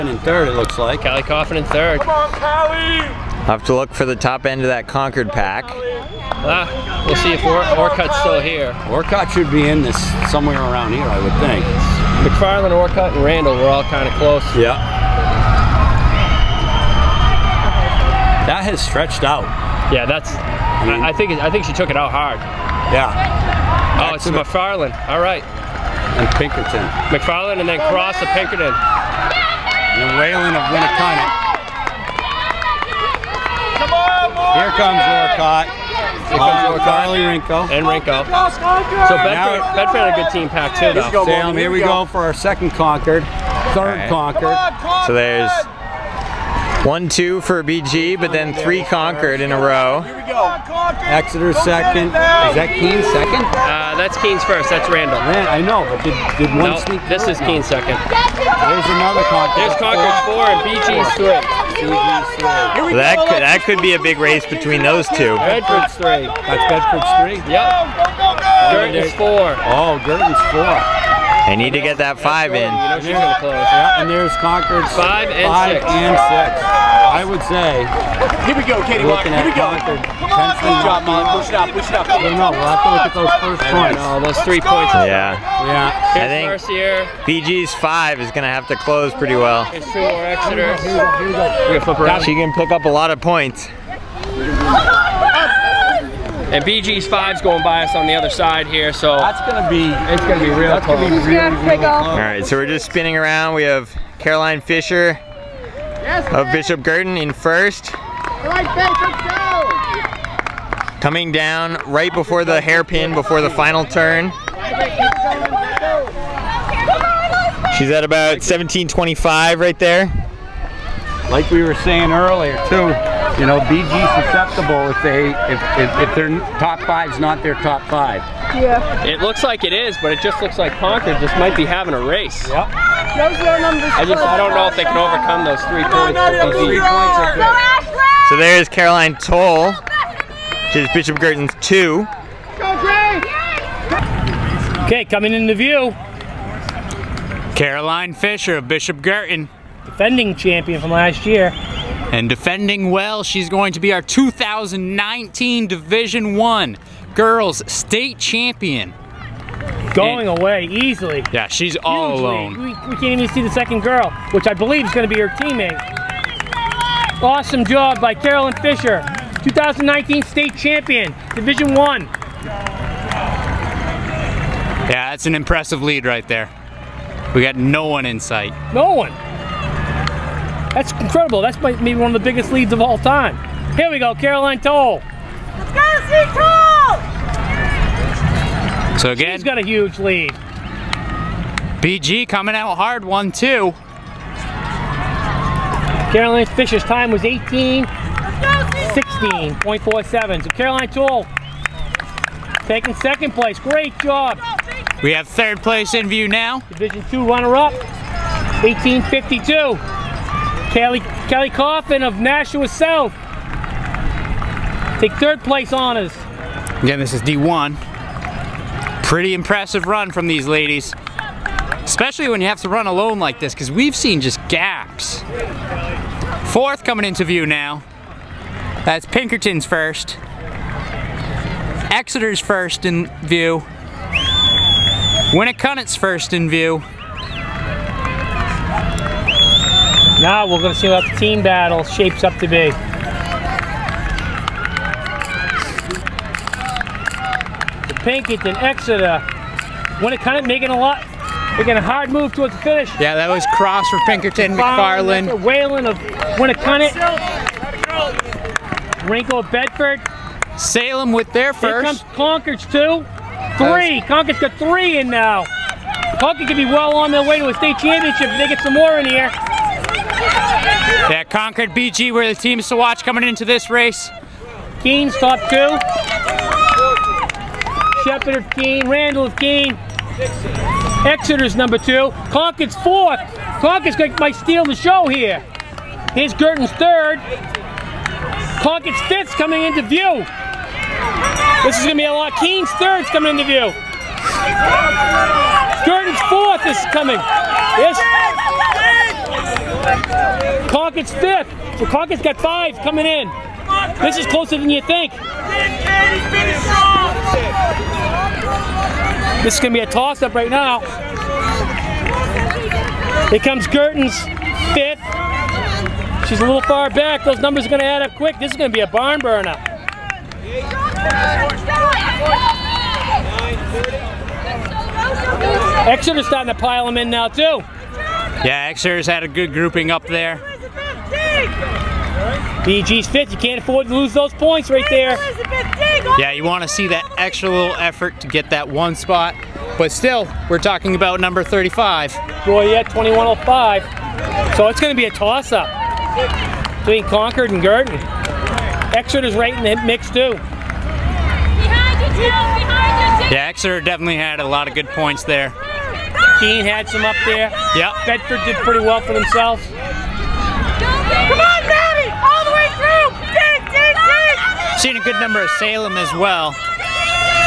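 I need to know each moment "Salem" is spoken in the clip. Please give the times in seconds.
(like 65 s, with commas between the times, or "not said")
260 s, 365 s.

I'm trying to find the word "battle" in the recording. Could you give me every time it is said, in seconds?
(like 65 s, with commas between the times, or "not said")
241 s.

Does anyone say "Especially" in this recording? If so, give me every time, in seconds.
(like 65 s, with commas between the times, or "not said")
221 s.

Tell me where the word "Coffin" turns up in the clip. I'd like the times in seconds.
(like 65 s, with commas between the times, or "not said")
1 s, 211 s.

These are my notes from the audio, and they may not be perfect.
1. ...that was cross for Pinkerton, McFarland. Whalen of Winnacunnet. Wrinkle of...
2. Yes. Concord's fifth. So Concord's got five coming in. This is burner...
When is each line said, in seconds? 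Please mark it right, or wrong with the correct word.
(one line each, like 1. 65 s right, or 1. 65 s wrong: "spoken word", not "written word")
1. 253 s right
2. 297 s wrong: "closer", not "burner".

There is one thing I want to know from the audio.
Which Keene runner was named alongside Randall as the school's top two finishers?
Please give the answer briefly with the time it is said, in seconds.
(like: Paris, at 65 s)
Shepherd, at 278 s.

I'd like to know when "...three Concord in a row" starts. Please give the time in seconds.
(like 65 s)
48 s.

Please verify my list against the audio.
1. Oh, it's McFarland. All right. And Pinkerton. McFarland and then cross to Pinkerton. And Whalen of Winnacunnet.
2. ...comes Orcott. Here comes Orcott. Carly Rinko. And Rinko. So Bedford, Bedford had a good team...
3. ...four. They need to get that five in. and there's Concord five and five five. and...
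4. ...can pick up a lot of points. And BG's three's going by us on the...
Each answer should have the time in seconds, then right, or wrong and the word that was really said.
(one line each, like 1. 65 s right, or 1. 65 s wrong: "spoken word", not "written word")
1. 24 s right
2. 34 s right
3. 70 s wrong: "six", not "five"
4. 92 s wrong: "five", not "three".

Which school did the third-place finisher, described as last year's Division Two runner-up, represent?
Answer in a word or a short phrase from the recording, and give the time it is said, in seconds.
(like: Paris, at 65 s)
Nashua South, at 212 s.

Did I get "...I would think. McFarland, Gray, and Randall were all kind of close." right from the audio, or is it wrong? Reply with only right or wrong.
wrong.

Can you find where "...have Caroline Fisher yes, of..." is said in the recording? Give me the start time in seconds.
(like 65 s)
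103 s.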